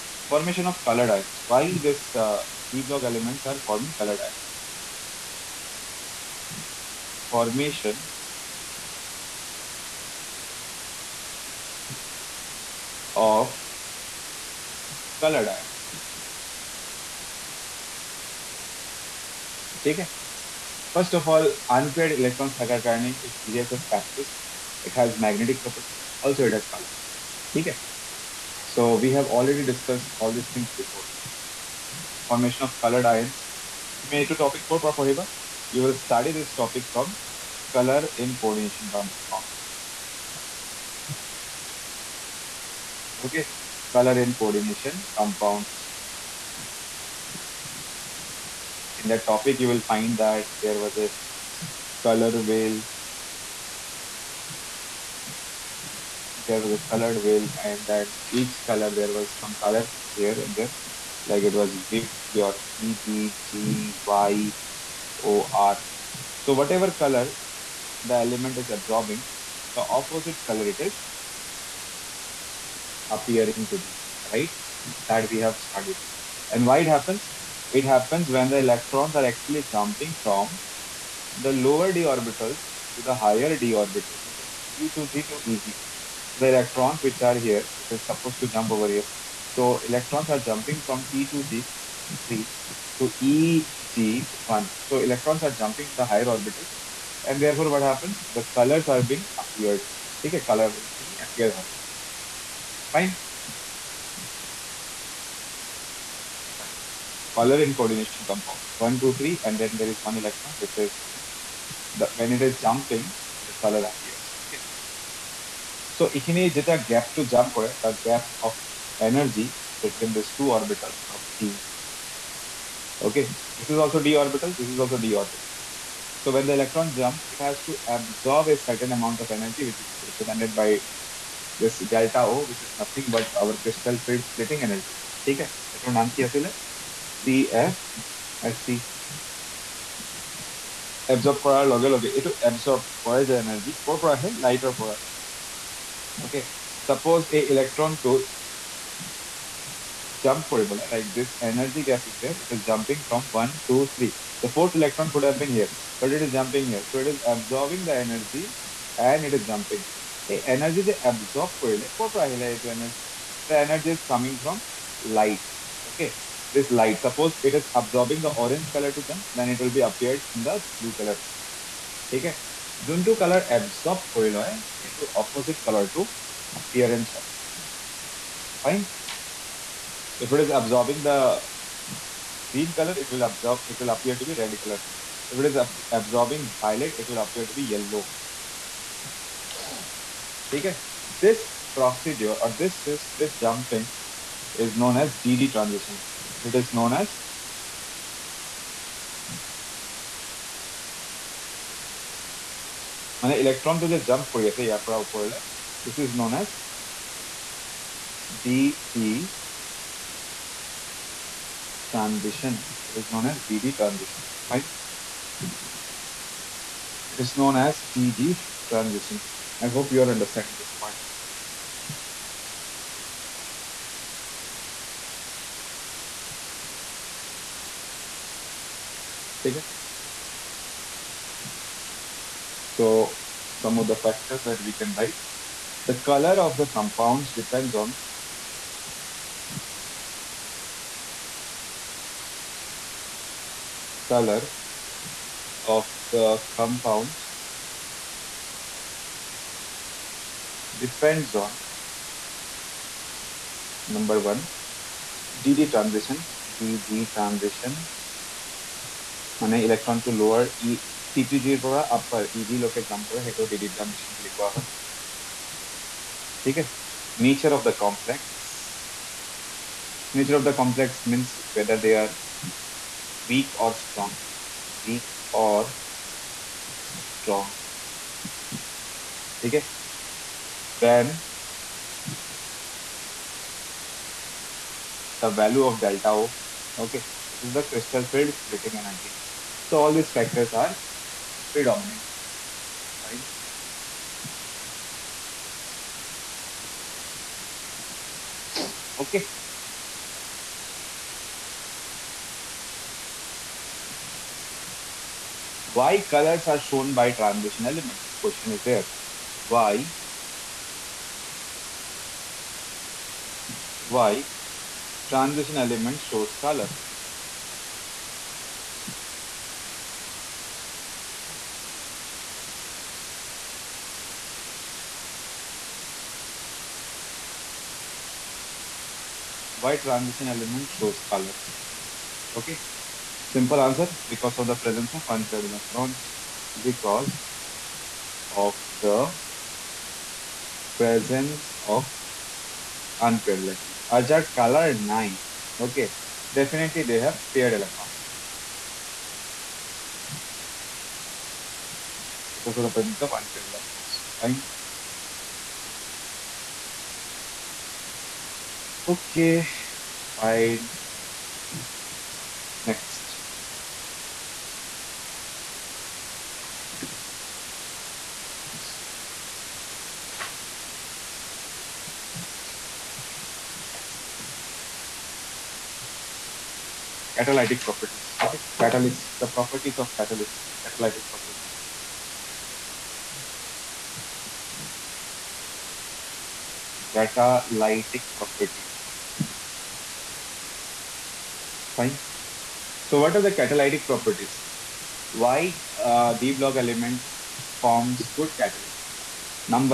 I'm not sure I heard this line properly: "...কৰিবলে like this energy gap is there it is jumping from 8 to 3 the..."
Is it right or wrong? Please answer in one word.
wrong.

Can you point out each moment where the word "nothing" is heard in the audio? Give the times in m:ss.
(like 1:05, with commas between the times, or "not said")
2:12.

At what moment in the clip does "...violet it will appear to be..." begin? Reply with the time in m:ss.
3:06.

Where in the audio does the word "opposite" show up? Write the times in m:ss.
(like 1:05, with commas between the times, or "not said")
1:09, 2:55.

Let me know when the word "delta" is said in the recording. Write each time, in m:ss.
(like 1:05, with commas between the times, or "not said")
2:11, 4:45.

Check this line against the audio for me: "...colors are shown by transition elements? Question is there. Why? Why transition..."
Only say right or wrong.
right.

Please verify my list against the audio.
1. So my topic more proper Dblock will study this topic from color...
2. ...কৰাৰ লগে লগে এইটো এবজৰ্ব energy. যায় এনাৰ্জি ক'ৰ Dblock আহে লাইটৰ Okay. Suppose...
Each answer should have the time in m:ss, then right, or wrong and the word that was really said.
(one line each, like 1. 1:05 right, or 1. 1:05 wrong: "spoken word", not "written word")
1. 0:33 wrong: "You", not "Dblock"
2. 2:21 wrong: "Light", not "Dblock".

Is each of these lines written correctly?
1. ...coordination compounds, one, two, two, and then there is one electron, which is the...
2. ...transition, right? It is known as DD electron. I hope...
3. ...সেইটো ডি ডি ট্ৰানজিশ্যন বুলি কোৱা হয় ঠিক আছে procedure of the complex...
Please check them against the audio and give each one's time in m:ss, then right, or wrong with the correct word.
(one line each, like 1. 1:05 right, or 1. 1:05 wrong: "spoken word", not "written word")
1. 1:47 wrong: "three", not "two"
2. 3:33 wrong: "transition", not "electron"
3. 4:23 wrong: "nature", not "procedure".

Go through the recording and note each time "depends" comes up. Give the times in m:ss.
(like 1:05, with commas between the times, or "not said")
3:57, 4:10.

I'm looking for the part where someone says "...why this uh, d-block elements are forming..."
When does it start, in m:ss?
0:01.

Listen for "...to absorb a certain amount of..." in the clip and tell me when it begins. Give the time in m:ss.
2:07.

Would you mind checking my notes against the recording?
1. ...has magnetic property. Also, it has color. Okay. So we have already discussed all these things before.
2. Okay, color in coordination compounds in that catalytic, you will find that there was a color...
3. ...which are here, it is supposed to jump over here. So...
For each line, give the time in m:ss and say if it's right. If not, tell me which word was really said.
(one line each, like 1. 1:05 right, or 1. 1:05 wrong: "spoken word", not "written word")
1. 0:24 right
2. 0:43 wrong: "topic", not "catalytic"
3. 1:27 right.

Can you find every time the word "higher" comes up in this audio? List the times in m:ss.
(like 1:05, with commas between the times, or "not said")
1:23, 1:36.